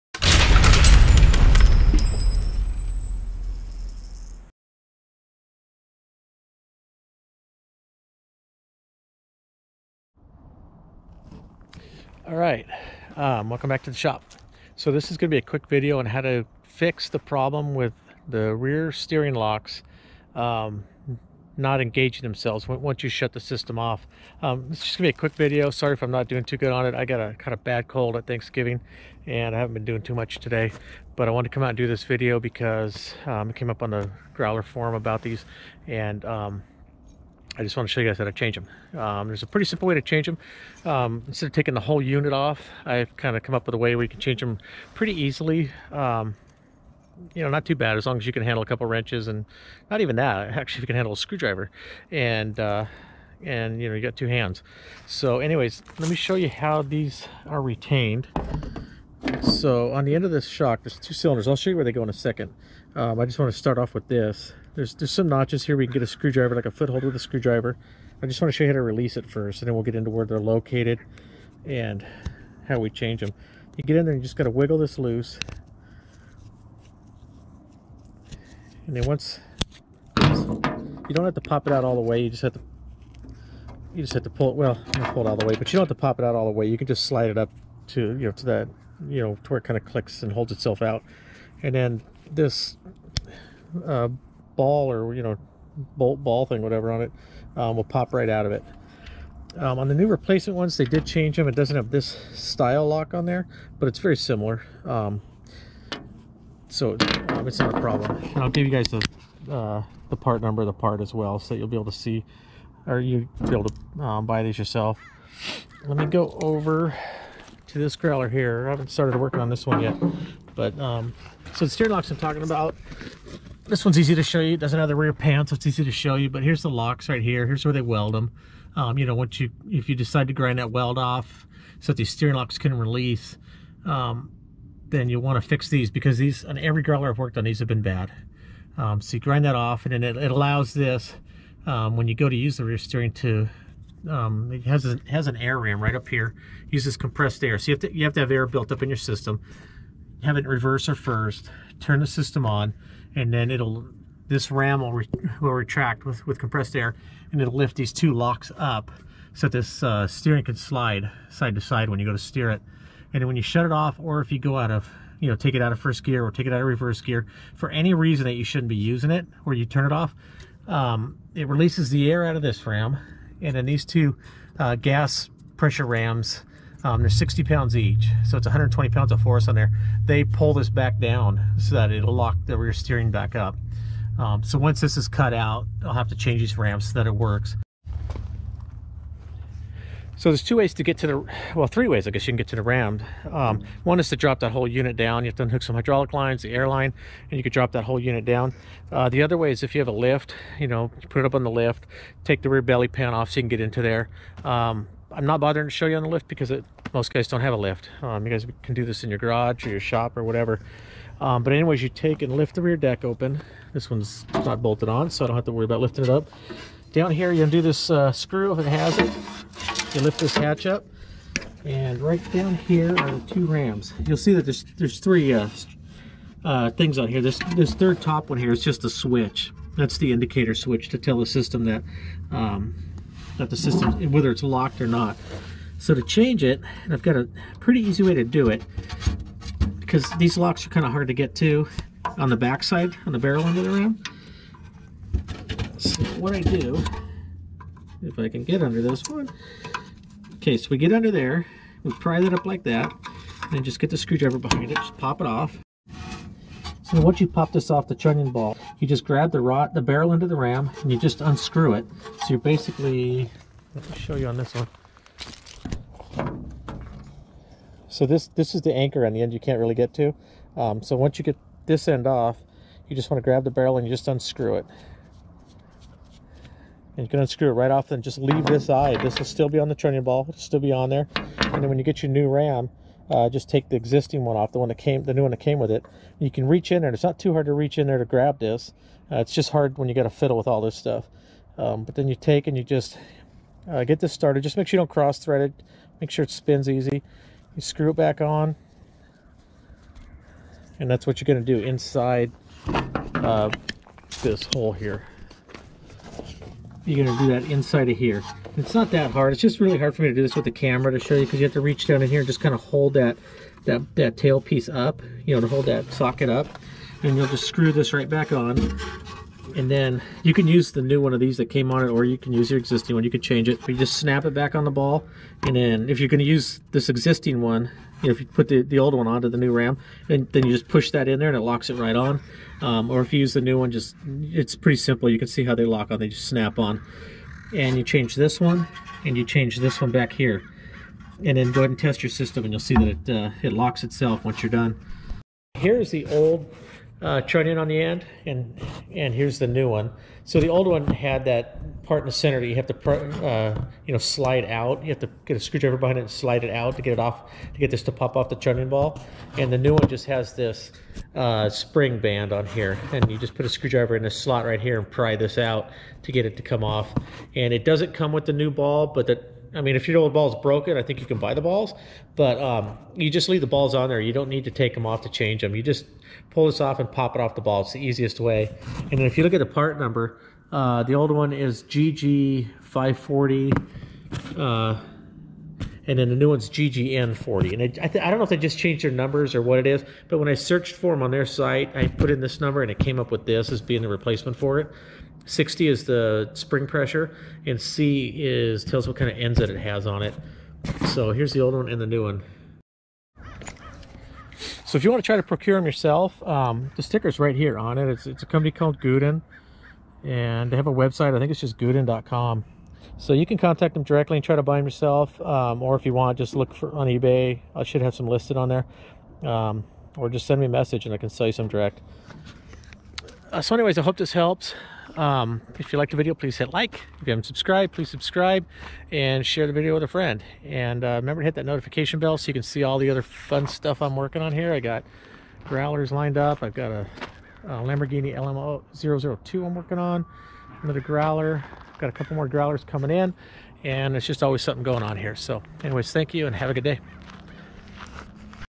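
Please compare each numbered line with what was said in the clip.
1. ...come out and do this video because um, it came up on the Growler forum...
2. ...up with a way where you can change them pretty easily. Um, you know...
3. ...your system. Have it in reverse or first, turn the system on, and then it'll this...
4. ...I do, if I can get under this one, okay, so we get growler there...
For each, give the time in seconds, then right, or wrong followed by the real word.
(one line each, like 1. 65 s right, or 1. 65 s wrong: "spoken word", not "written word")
1. 31 s right
2. 43 s right
3. 148 s right
4. 246 s wrong: "under", not "growler".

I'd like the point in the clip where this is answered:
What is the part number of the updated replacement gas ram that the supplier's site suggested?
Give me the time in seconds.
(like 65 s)
386 s.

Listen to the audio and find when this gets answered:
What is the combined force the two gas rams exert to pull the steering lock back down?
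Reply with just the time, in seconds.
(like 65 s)
178 s.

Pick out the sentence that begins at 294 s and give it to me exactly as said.
Just make sure you don't cross thread it.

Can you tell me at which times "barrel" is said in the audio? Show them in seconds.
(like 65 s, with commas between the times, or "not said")
243 s, 259 s, 273 s.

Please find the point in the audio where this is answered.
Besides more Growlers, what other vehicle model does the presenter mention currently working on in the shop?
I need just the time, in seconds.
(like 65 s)
437 s.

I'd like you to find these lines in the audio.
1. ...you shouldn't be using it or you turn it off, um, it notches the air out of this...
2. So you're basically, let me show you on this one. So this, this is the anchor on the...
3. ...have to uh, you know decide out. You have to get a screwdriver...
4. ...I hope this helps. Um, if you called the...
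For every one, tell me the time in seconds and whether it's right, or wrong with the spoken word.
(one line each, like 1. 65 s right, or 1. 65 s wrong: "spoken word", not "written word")
1. 168 s wrong: "releases", not "notches"
2. 262 s right
3. 352 s wrong: "slide", not "decide"
4. 423 s wrong: "liked", not "called".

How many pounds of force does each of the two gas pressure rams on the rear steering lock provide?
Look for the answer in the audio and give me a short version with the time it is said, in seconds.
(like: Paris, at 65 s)
60, at 177 s.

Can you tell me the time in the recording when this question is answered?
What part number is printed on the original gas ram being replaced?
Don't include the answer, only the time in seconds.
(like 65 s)
381 s.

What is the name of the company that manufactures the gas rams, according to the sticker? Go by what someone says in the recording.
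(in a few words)
Guden.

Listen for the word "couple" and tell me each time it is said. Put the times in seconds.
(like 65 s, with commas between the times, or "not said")
48 s, 441 s.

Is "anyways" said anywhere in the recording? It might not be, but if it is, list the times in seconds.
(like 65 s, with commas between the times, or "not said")
55 s, 211 s, 423 s, 445 s.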